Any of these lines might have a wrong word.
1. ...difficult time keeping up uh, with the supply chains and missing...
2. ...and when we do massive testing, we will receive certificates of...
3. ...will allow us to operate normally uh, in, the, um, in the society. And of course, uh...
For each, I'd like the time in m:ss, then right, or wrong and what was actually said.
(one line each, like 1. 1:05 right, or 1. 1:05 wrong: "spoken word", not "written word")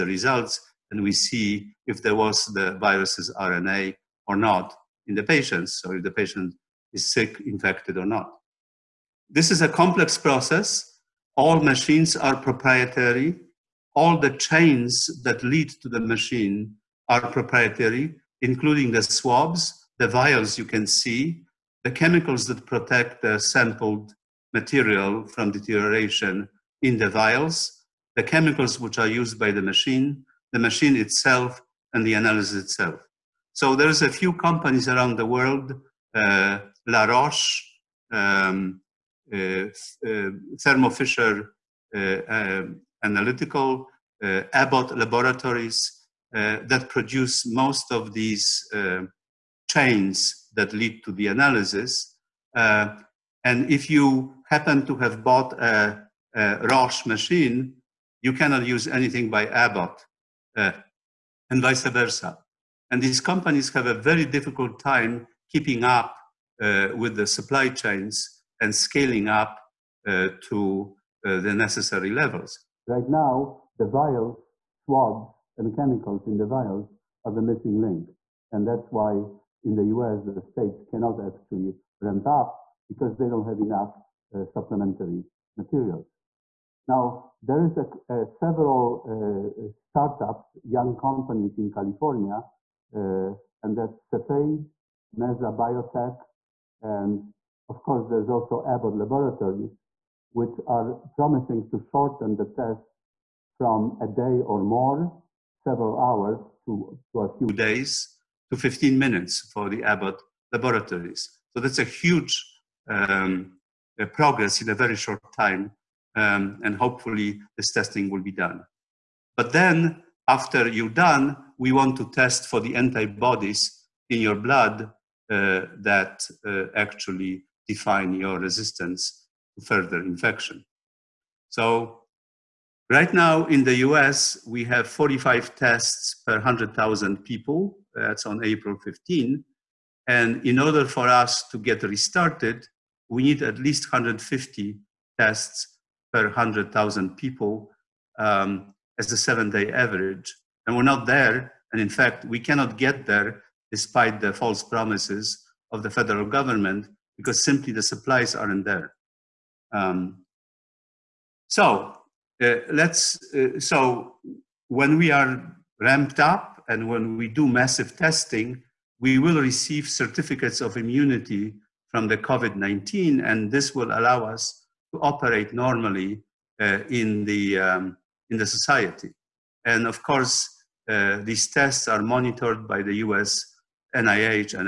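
1. 1:04 wrong: "scaling", not "missing"
2. 2:46 right
3. 2:53 right.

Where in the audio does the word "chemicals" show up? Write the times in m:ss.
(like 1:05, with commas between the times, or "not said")
0:21, 0:28, 1:15.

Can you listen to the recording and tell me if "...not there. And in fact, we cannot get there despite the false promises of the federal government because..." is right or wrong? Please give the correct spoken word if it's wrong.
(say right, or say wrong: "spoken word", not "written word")
right.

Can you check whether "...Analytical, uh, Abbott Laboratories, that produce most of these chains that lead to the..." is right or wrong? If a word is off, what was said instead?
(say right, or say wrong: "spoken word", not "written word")
right.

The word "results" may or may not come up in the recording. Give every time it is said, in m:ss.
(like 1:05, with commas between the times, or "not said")
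0:00.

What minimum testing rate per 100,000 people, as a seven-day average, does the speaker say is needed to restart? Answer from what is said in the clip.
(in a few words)
150.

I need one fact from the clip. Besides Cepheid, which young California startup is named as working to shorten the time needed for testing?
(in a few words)
Mesa Biotech.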